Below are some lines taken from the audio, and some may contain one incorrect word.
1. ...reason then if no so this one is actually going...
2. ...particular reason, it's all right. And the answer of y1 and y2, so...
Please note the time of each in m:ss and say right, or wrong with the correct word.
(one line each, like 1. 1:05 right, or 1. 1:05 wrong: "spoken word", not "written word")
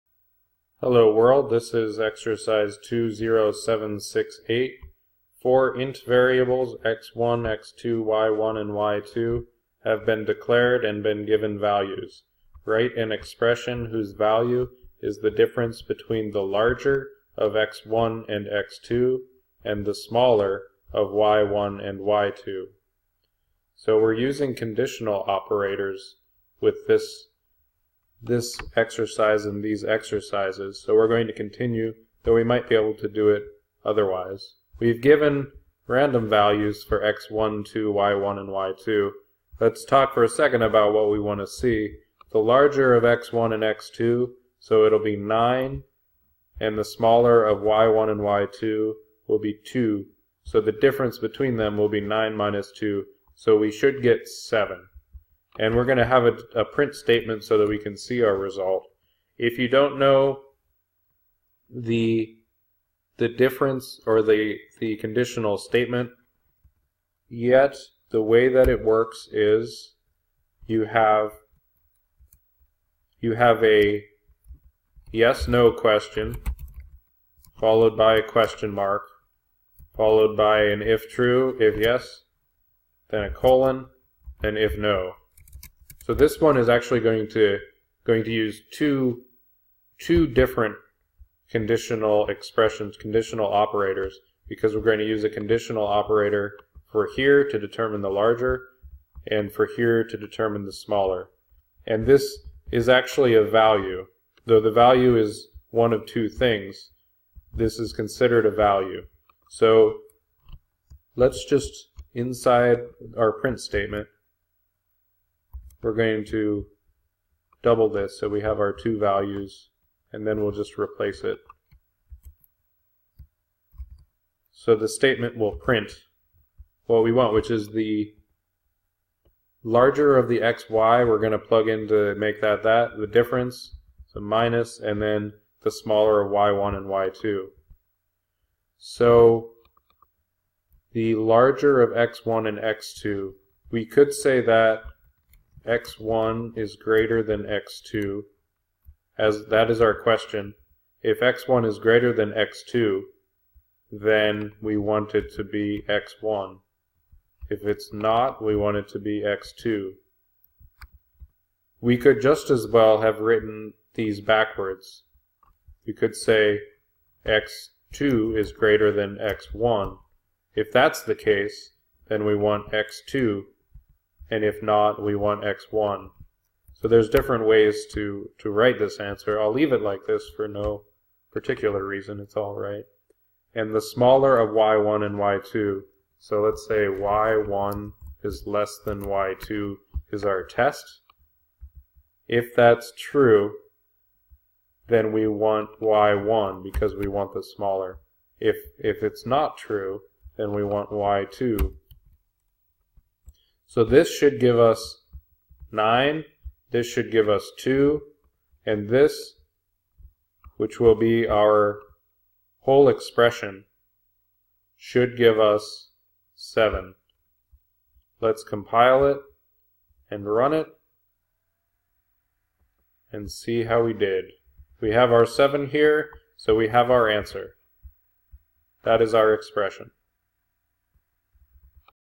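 1. 1:23 wrong: "colon", not "reason"
2. 3:01 wrong: "smaller", not "answer".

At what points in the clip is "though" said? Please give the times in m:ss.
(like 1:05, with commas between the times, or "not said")
0:32, 1:44.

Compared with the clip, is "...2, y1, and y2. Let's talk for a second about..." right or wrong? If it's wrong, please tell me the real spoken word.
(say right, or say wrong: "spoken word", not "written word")
right.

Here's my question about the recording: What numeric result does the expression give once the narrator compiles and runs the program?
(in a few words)
7.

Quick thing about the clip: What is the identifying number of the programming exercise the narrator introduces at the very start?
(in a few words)
20768.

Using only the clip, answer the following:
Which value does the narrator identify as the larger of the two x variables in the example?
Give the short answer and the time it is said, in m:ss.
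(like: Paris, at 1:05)
9, at 0:44.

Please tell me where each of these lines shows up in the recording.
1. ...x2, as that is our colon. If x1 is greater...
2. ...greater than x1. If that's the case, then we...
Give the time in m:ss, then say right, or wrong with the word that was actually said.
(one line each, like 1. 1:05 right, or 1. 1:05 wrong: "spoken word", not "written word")
1. 2:27 wrong: "question", not "colon"
2. 2:48 right.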